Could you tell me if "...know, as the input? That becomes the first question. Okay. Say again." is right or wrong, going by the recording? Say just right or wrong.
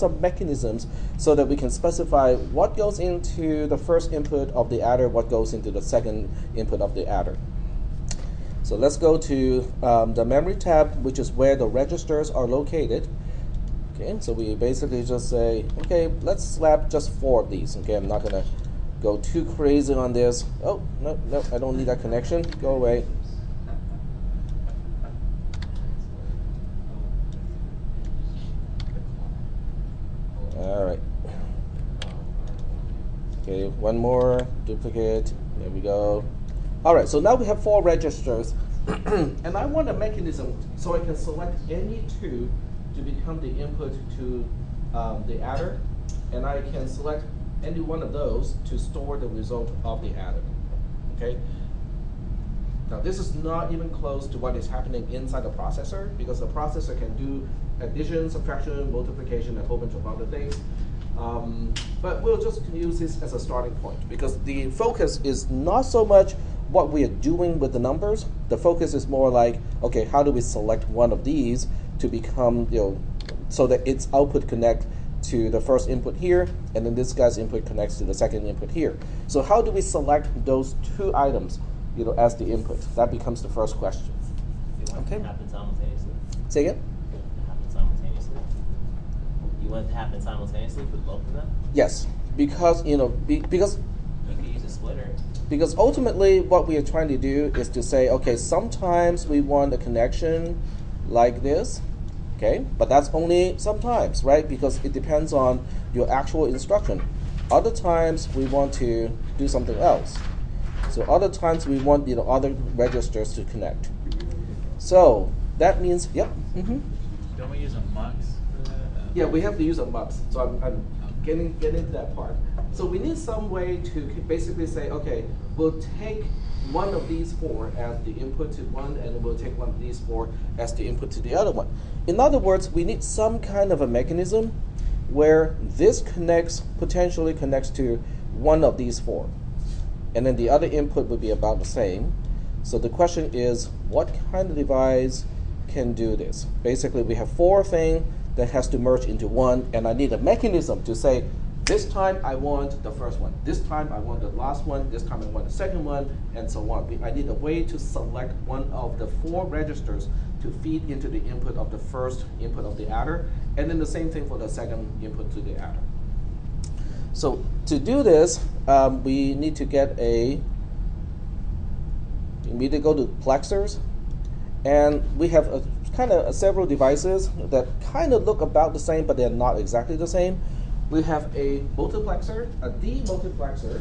right.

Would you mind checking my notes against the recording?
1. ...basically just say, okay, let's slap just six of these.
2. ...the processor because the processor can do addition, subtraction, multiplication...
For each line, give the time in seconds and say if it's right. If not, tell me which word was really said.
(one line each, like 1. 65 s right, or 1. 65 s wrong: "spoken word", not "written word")
1. 14 s wrong: "four", not "six"
2. 55 s right.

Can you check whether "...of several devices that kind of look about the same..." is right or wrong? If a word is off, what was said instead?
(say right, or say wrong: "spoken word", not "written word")
right.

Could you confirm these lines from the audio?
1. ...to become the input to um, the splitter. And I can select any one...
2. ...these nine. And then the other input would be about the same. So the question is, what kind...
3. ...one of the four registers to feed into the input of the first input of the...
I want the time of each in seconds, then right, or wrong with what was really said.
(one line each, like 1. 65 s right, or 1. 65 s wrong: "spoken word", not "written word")
1. 42 s wrong: "adder", not "splitter"
2. 138 s wrong: "four", not "nine"
3. 158 s right.